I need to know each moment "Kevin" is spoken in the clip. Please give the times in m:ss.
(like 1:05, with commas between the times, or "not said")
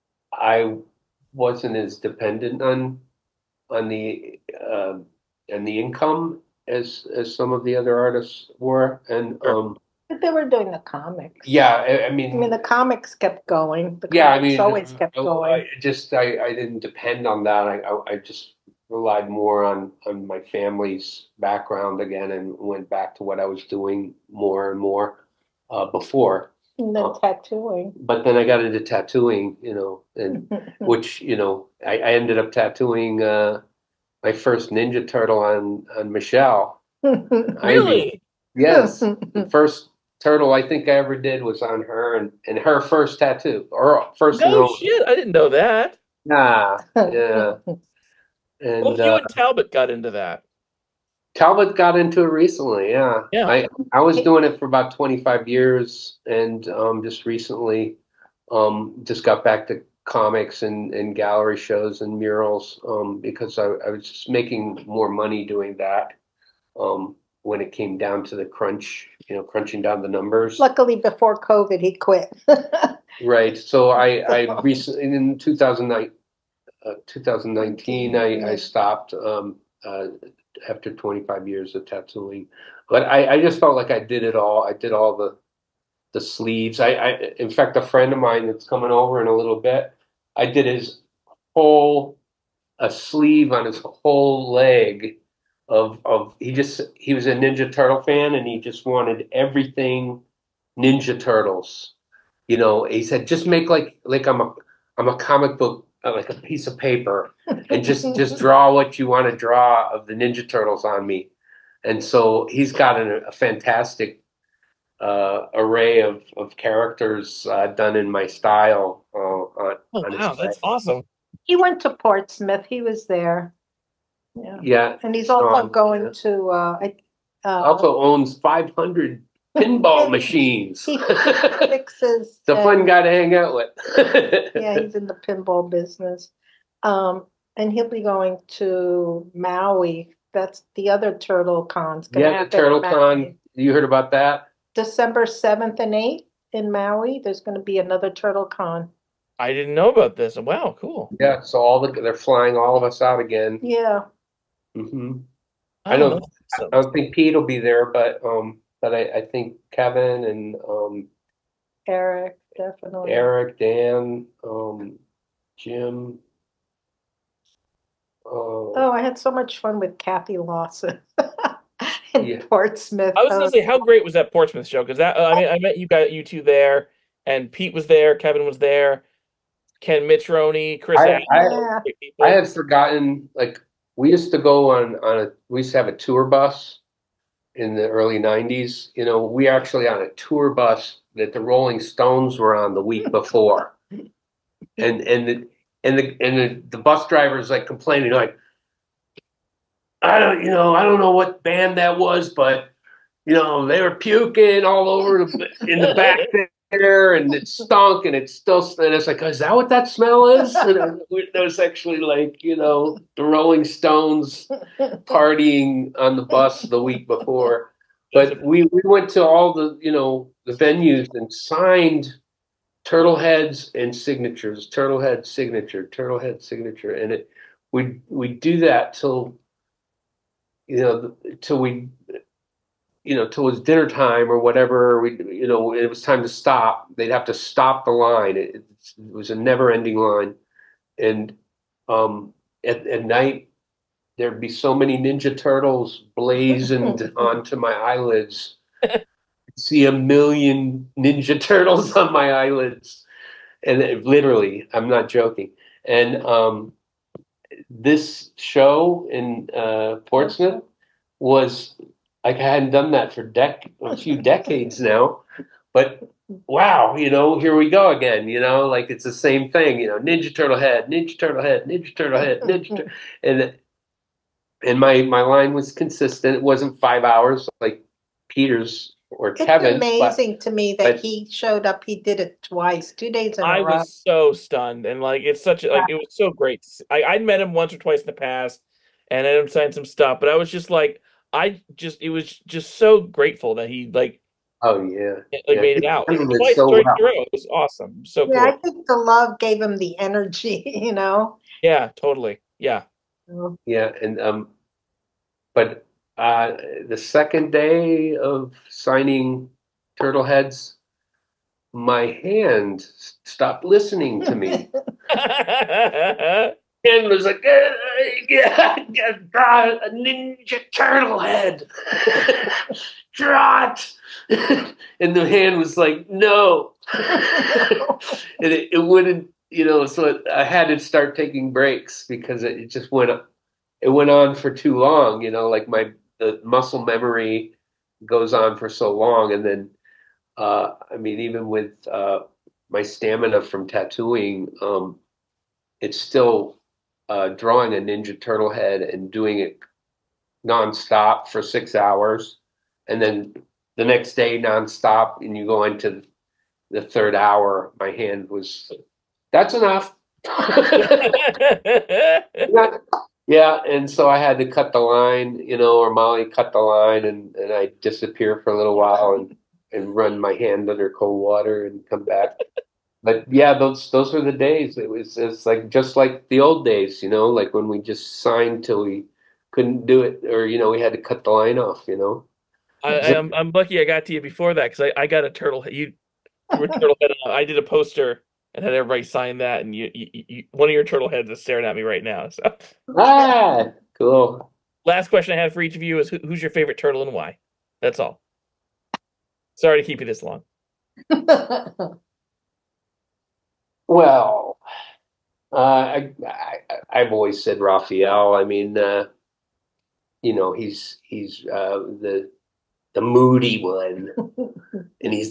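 2:39, 2:58, 4:39.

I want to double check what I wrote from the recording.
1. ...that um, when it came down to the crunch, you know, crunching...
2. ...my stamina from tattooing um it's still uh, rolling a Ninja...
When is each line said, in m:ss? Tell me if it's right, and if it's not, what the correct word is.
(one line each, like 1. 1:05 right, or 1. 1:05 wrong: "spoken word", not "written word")
1. 1:05 right
2. 5:42 wrong: "drawing", not "rolling".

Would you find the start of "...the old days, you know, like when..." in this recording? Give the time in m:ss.
6:16.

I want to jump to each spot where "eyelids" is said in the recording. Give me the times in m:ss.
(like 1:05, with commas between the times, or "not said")
4:07, 4:12.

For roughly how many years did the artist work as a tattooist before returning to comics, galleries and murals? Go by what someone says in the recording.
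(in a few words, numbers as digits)
25.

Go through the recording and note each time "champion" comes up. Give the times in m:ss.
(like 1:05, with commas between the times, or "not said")
not said.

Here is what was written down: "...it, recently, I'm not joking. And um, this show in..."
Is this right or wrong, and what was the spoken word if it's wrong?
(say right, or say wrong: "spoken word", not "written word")
wrong: "literally", not "recently".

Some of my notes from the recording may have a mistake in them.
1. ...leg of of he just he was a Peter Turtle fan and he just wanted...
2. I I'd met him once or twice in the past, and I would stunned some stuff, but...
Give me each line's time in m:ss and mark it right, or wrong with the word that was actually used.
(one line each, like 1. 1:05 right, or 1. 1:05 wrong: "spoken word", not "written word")
1. 1:34 wrong: "Ninja", not "Peter"
2. 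4:46 wrong: "signed", not "stunned".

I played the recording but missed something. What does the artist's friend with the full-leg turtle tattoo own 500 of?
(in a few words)
pinball machines.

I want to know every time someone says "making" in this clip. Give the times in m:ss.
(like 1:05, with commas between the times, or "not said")
1:04.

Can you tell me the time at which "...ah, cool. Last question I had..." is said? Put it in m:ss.
6:32.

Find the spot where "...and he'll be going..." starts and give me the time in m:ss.
2:17.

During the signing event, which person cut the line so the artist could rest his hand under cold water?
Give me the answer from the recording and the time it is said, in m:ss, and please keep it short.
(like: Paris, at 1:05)
Molly, at 6:05.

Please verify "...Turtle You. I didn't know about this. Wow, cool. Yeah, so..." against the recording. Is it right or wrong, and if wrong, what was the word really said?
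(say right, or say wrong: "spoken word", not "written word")
wrong: "Con", not "You".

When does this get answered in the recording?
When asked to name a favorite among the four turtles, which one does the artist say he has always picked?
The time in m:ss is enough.
6:47.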